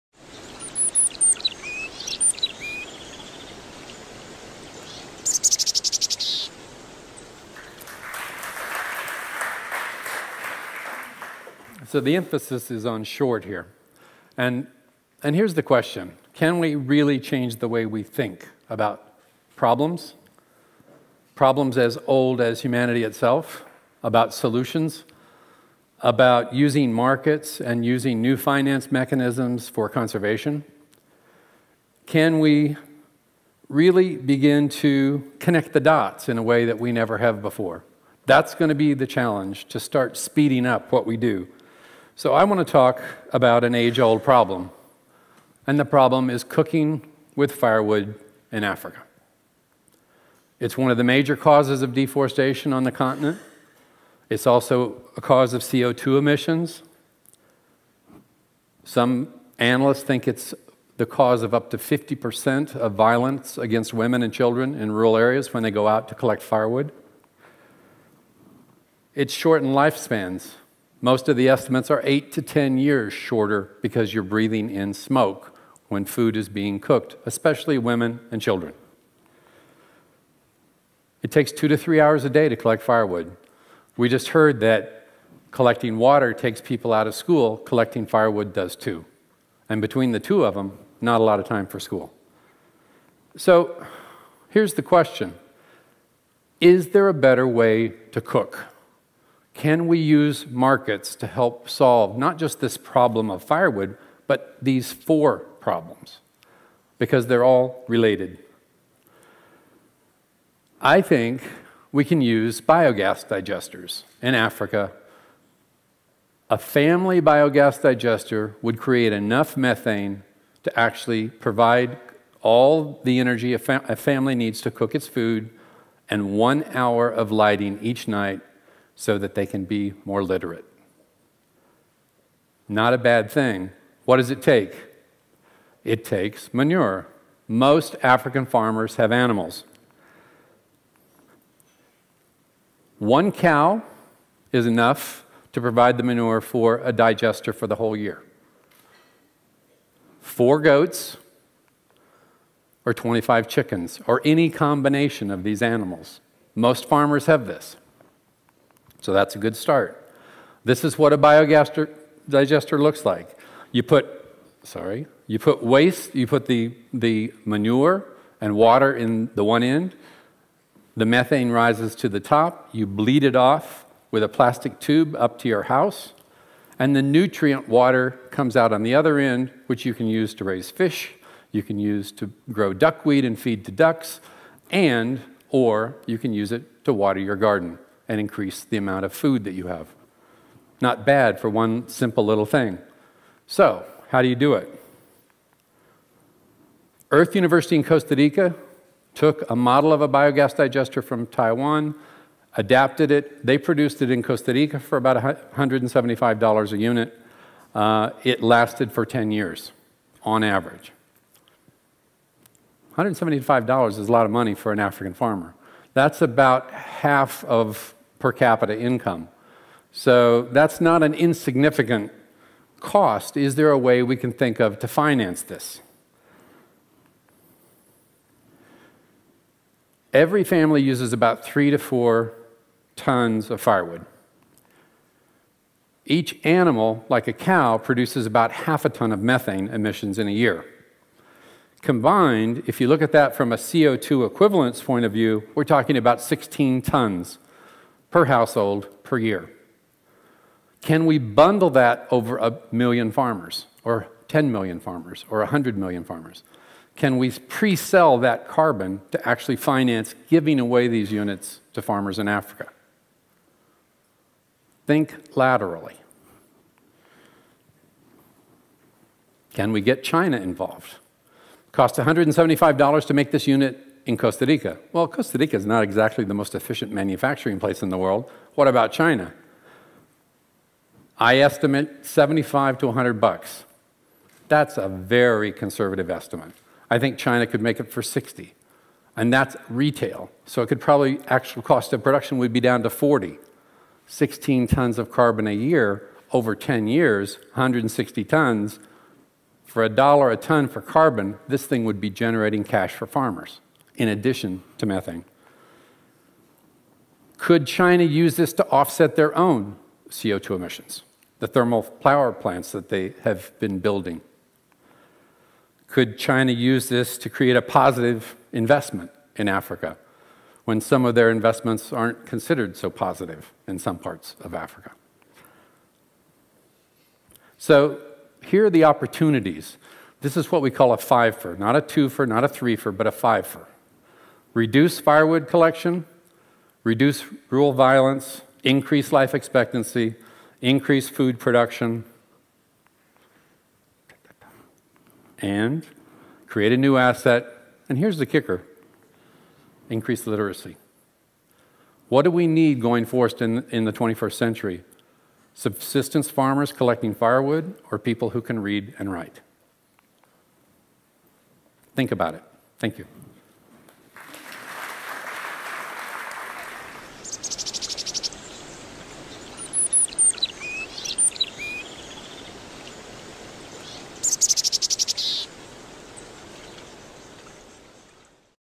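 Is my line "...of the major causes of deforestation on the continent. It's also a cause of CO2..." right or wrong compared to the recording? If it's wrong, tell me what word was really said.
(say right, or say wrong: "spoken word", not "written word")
right.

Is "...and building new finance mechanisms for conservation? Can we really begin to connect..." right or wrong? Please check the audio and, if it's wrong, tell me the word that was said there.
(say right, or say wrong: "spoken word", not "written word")
wrong: "using", not "building".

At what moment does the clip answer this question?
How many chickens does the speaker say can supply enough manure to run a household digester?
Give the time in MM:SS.
02:32.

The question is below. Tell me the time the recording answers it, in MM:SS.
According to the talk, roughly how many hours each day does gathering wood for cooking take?
01:21.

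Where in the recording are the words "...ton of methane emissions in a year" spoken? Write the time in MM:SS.
03:58.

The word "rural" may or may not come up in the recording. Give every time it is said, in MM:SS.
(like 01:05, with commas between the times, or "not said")
01:04, 05:37.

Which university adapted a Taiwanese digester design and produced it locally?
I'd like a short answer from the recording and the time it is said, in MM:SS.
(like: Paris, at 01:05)
Earth University, at 03:17.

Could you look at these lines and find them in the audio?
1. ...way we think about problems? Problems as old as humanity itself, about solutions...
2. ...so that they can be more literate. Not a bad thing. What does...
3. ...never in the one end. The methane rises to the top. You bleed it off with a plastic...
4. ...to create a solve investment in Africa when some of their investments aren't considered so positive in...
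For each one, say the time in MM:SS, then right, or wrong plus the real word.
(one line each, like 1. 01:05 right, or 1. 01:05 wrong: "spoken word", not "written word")
1. 00:17 right
2. 02:09 right
3. 02:48 wrong: "water", not "never"
4. 05:17 wrong: "positive", not "solve".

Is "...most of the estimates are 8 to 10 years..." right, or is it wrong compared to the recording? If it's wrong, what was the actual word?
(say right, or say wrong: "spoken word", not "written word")
right.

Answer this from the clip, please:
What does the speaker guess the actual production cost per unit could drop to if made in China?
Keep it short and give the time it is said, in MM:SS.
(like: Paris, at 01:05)
$40, at 04:52.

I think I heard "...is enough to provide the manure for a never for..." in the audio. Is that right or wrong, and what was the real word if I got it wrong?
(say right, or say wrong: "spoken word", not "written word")
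wrong: "digester", not "never".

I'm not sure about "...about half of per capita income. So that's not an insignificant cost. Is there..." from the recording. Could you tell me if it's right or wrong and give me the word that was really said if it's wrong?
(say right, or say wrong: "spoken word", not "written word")
right.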